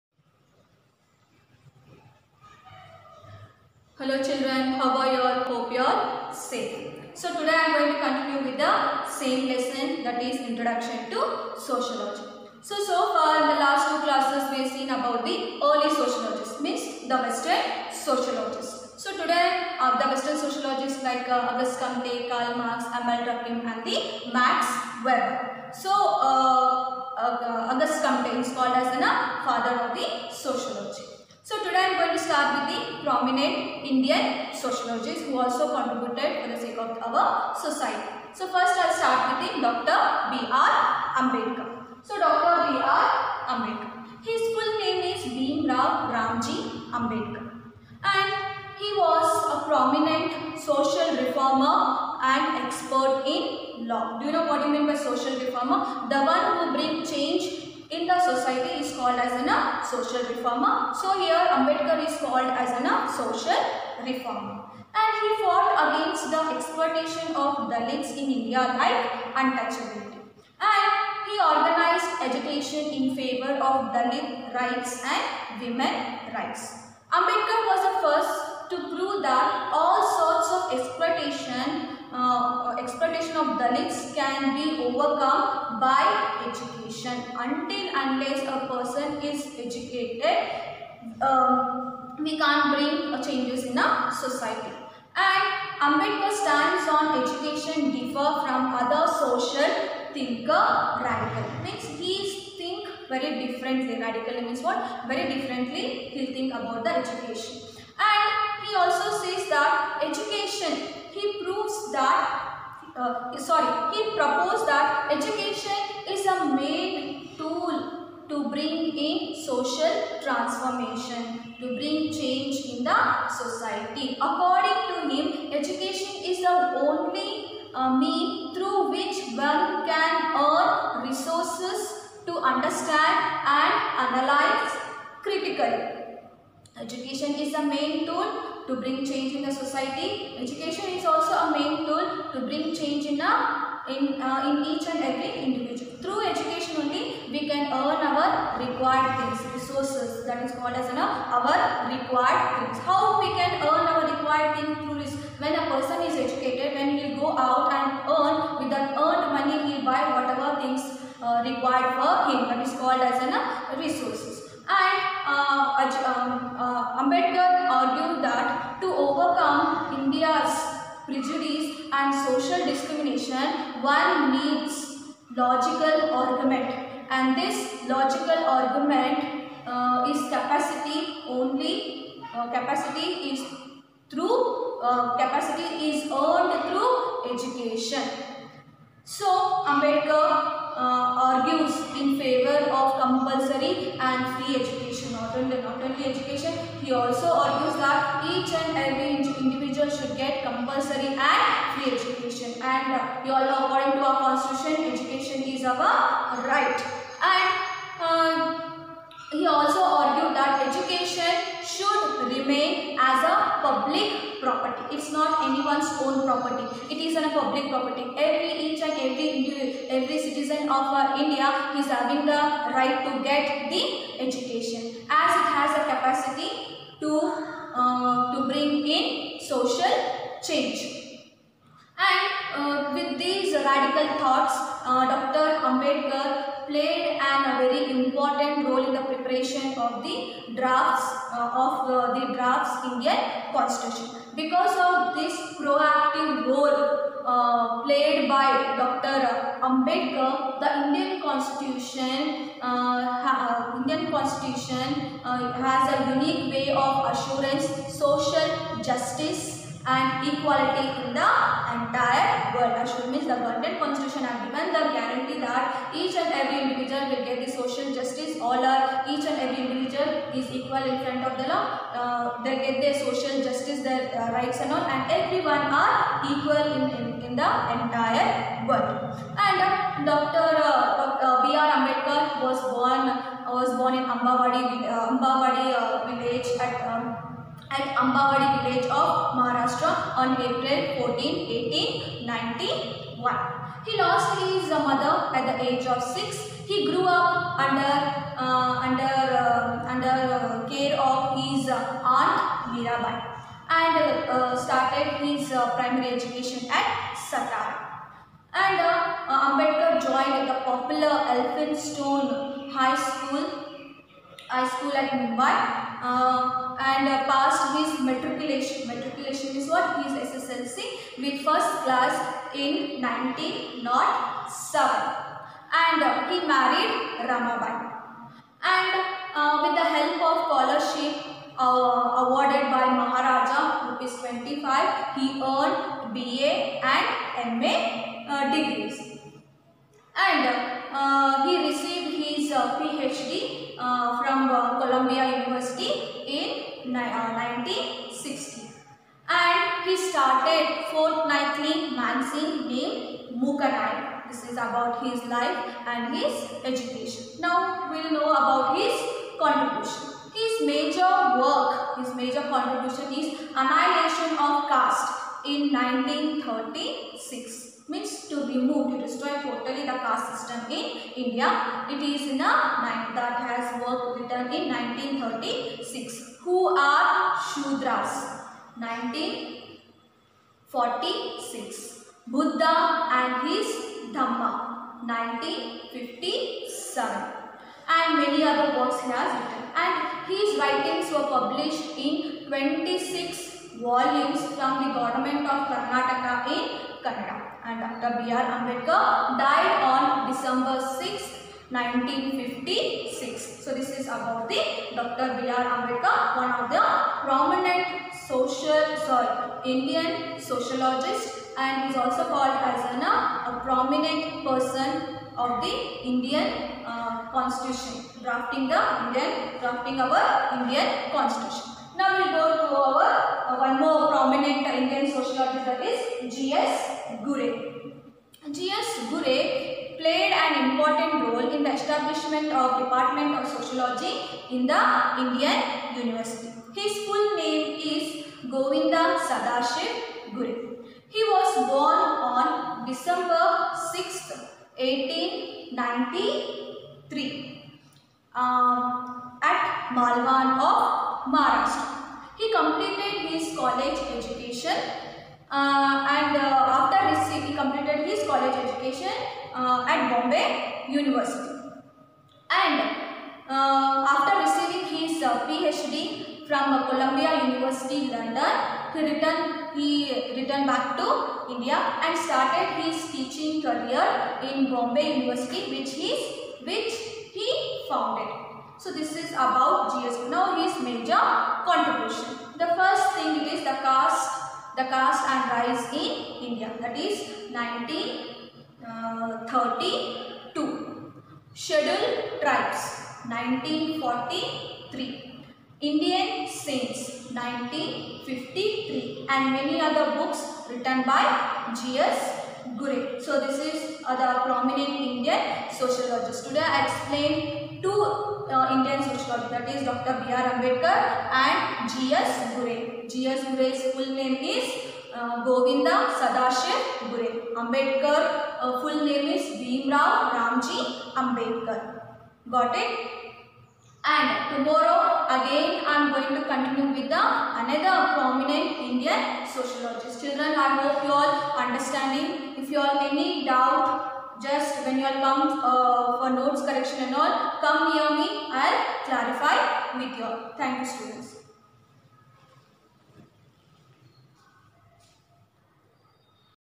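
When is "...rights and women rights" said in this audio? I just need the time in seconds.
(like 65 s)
74 s.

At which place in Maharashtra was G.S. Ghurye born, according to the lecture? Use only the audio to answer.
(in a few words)
Malwan.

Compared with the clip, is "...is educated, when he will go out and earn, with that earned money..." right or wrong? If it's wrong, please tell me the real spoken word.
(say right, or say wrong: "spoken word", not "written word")
right.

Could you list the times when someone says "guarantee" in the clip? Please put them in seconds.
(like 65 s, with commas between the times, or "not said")
264 s.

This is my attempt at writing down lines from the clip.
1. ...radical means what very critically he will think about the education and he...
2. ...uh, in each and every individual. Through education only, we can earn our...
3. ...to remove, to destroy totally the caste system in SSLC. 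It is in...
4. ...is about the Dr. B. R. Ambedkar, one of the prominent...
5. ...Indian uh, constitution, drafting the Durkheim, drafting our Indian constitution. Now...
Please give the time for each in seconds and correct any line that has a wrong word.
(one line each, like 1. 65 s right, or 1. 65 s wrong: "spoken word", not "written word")
1. 104 s wrong: "differently", not "critically"
2. 144 s right
3. 368 s wrong: "India", not "SSLC"
4. 403 s right
5. 416 s wrong: "Indian", not "Durkheim".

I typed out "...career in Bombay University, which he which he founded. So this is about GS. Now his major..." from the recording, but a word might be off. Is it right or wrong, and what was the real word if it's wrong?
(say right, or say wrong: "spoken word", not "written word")
right.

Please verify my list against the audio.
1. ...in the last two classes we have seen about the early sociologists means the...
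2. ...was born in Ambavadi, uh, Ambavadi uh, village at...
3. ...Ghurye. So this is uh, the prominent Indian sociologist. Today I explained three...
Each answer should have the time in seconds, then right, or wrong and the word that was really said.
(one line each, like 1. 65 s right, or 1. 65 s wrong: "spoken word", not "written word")
1. 13 s right
2. 283 s right
3. 502 s wrong: "two", not "three".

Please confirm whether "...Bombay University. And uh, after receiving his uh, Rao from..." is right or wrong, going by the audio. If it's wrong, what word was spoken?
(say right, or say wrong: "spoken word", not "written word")
wrong: "PhD", not "Rao".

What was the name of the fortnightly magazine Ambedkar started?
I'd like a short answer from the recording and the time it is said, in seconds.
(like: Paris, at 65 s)
Mooknayak, at 353 s.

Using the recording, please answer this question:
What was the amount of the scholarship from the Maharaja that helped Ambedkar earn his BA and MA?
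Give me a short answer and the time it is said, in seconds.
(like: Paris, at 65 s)
Rs 25, at 333 s.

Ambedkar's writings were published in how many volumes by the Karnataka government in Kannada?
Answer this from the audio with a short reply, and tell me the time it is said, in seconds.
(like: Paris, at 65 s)
26, at 392 s.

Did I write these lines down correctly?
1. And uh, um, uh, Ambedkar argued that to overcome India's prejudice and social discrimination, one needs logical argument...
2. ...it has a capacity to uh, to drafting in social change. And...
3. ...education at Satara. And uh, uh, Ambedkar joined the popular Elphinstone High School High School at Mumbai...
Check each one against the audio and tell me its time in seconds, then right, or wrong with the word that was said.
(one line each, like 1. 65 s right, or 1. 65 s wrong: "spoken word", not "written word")
1. 164 s right
2. 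225 s wrong: "bring", not "drafting"
3. 306 s right.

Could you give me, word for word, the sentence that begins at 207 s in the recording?
And um, he also argued that education should remain as a public property.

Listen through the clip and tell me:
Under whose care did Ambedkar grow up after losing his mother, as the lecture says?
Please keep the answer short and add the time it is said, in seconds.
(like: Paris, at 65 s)
Mirabai, at 301 s.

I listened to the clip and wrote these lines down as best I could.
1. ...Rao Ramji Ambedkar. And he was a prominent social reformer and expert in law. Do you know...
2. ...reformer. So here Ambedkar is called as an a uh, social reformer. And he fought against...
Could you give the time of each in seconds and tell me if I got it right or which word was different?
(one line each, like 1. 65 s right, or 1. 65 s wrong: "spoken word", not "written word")
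1. 45 s right
2. 60 s right.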